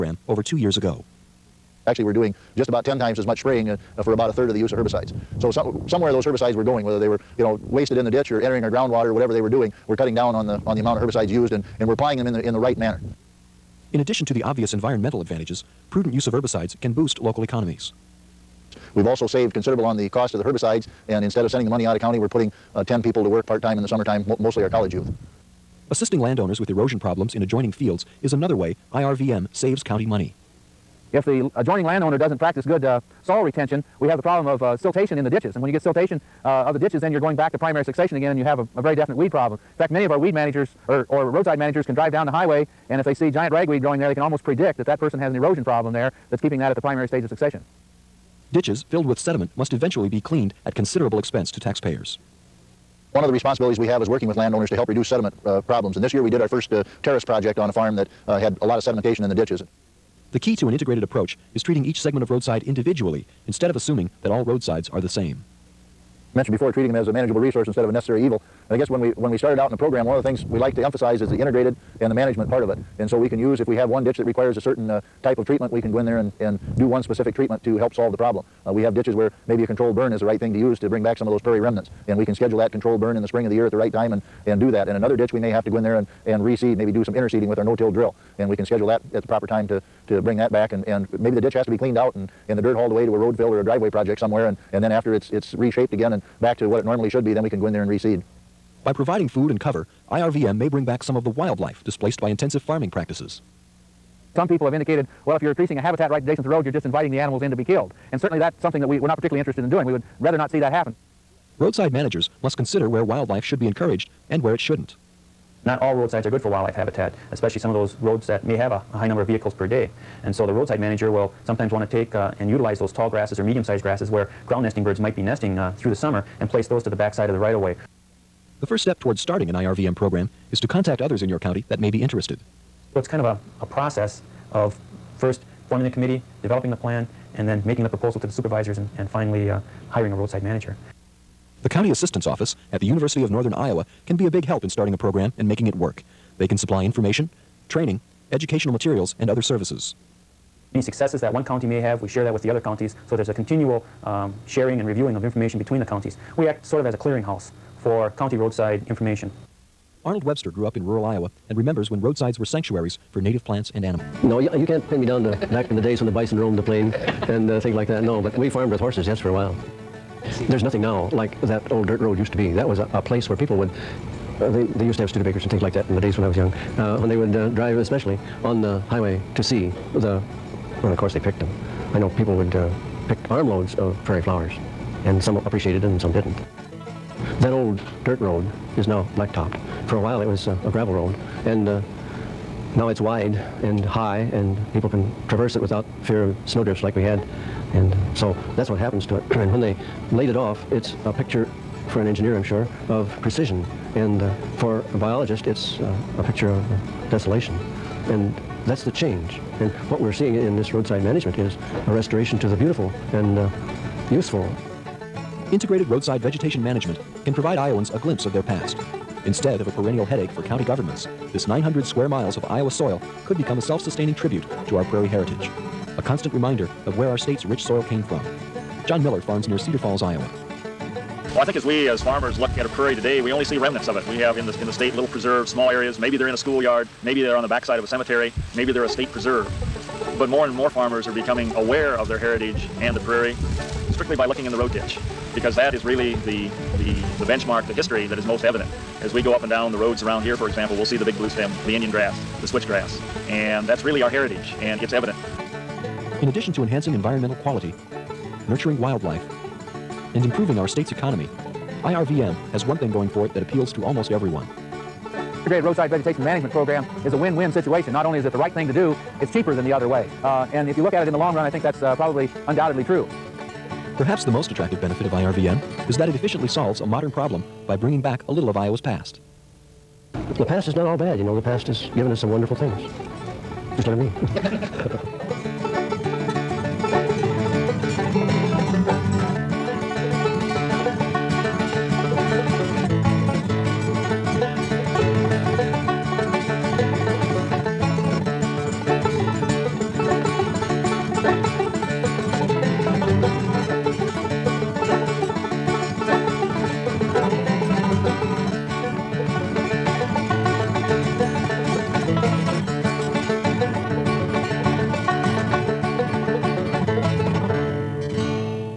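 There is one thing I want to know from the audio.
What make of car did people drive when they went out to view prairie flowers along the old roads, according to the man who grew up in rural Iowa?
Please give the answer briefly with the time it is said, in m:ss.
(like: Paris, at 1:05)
Studebakers, at 2:55.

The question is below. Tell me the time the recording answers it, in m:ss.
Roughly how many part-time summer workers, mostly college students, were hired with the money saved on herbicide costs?
0:22.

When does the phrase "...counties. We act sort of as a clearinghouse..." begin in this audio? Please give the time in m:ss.
2:35.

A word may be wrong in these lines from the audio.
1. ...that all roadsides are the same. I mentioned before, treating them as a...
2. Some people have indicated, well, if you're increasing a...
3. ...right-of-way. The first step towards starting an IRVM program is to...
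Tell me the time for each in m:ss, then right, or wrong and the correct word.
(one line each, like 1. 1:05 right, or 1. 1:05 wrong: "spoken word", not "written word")
1. 1:04 right
2. 1:44 right
3. 2:07 right.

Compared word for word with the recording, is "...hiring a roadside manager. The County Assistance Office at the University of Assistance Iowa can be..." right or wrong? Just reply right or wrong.
wrong.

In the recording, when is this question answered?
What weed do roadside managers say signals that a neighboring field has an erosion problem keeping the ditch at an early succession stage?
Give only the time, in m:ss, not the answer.
0:43.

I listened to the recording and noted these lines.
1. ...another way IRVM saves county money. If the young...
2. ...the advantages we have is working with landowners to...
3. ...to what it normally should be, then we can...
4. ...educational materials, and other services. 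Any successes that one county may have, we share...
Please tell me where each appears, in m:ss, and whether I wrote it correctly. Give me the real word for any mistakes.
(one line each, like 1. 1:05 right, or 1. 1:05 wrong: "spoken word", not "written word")
1. 0:28 wrong: "adjoining", not "young"
2. 0:53 wrong: "responsibilities", not "advantages"
3. 1:36 right
4. 2:28 right.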